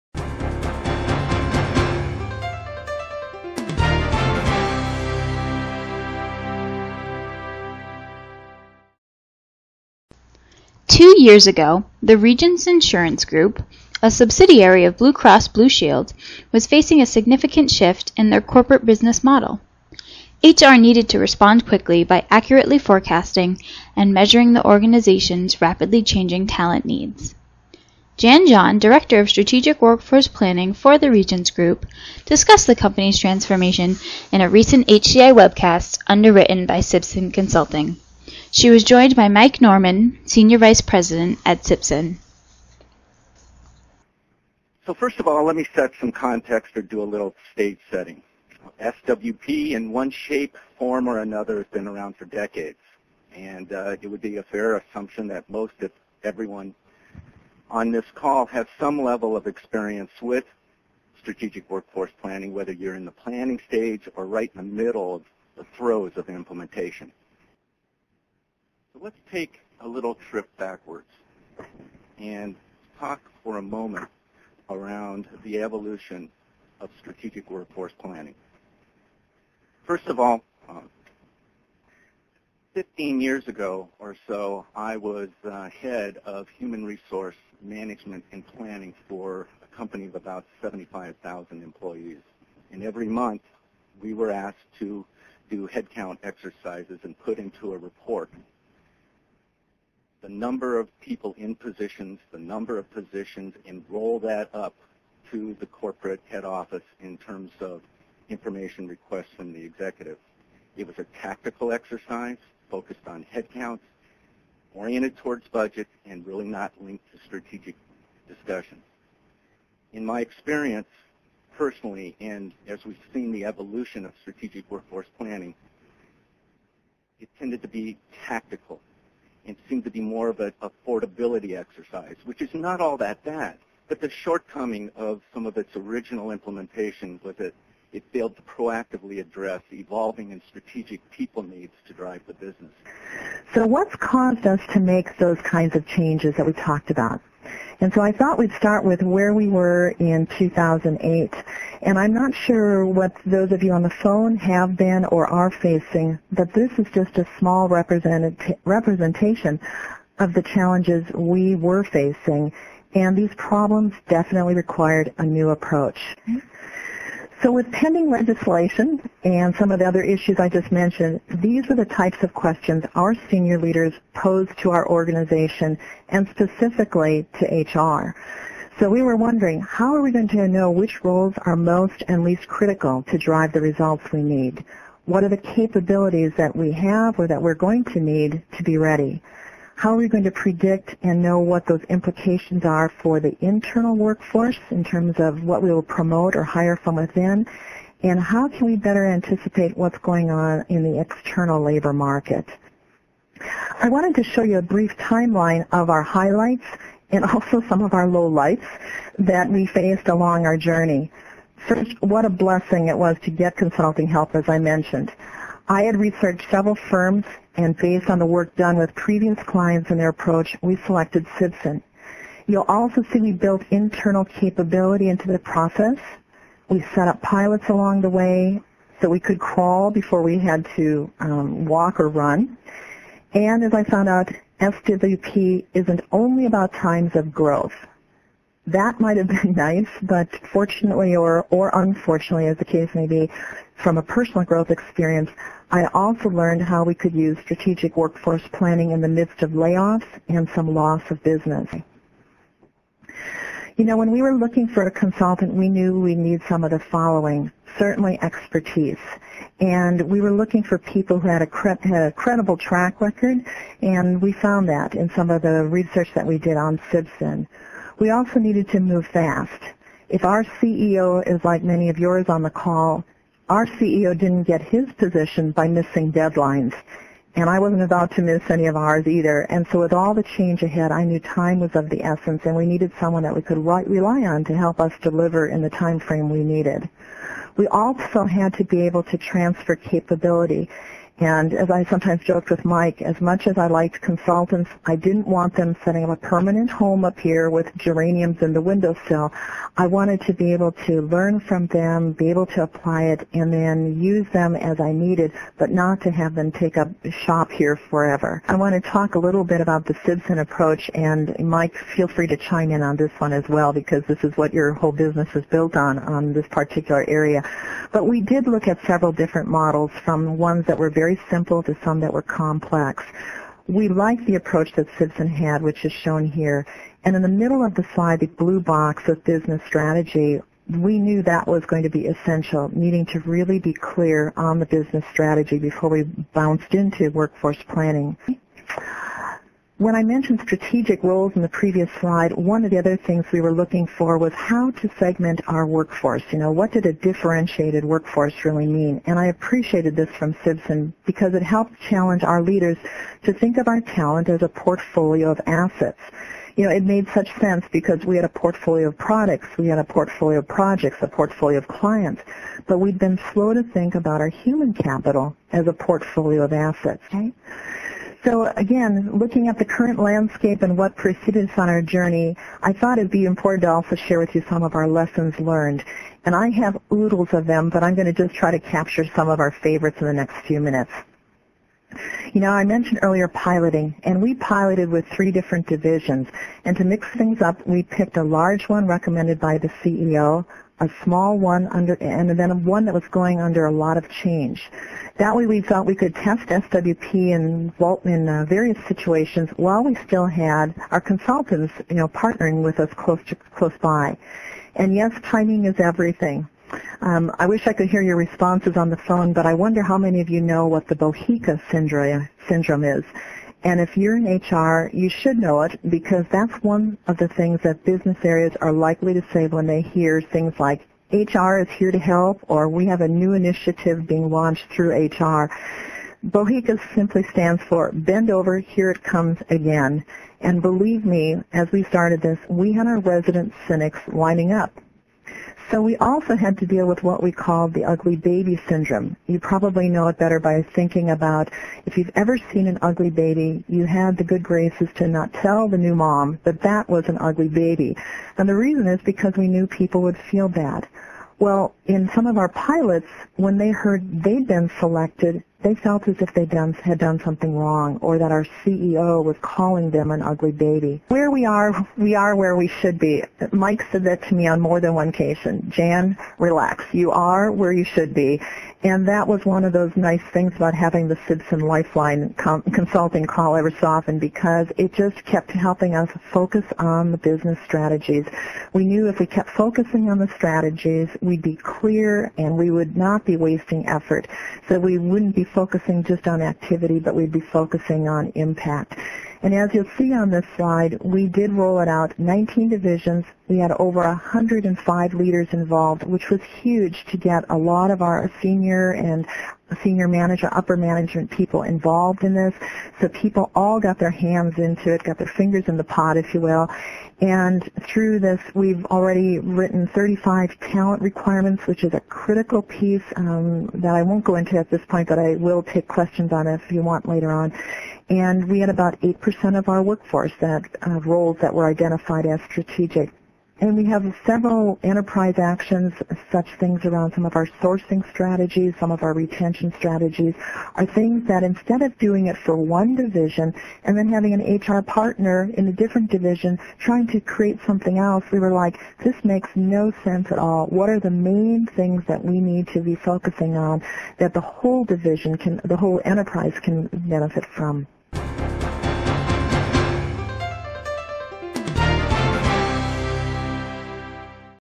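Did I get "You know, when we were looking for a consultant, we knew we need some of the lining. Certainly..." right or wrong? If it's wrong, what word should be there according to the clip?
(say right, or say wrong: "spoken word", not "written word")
wrong: "following", not "lining".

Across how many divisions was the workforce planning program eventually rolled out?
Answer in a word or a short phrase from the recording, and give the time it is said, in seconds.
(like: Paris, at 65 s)
19, at 492 s.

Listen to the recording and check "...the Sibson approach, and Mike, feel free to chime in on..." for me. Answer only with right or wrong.
right.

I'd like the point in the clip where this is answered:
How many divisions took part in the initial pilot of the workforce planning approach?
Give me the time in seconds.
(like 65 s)
385 s.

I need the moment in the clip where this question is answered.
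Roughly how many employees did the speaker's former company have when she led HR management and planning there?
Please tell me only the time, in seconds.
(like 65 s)
90 s.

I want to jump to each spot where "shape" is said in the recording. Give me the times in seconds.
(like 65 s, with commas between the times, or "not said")
50 s.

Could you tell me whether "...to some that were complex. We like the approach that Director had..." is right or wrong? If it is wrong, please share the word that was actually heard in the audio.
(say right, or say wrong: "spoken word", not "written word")
wrong: "Sibson", not "Director".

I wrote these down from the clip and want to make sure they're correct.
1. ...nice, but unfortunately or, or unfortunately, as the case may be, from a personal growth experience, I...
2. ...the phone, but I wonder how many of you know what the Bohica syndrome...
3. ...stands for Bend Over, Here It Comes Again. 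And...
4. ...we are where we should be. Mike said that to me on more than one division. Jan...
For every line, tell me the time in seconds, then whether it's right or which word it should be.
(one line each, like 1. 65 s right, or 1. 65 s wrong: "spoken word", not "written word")
1. 239 s wrong: "fortunately", not "unfortunately"
2. 408 s right
3. 427 s right
4. 461 s wrong: "occasion", not "division".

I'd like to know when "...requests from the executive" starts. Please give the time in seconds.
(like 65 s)
108 s.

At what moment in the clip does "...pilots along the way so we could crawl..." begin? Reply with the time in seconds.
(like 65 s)
227 s.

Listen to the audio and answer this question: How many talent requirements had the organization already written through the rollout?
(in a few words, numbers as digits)
35.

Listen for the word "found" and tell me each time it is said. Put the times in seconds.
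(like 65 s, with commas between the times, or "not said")
233 s, 264 s.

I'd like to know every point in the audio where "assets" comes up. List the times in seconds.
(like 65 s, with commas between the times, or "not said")
355 s, 366 s.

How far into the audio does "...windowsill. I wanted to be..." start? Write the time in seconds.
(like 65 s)
298 s.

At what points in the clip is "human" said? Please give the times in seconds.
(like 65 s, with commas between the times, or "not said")
86 s, 364 s.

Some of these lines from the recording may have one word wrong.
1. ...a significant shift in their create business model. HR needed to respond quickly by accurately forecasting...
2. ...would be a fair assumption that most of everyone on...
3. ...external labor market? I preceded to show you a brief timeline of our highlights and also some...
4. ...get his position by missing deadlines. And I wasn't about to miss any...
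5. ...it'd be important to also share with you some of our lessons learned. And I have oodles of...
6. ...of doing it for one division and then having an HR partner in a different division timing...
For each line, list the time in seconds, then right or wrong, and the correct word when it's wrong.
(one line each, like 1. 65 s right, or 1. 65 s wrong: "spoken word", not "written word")
1. 17 s wrong: "corporate", not "create"
2. 54 s right
3. 200 s wrong: "wanted", not "preceded"
4. 274 s right
5. 372 s right
6. 531 s wrong: "trying", not "timing".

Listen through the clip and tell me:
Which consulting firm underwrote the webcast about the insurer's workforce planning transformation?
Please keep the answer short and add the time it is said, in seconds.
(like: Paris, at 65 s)
Sibson Consulting, at 36 s.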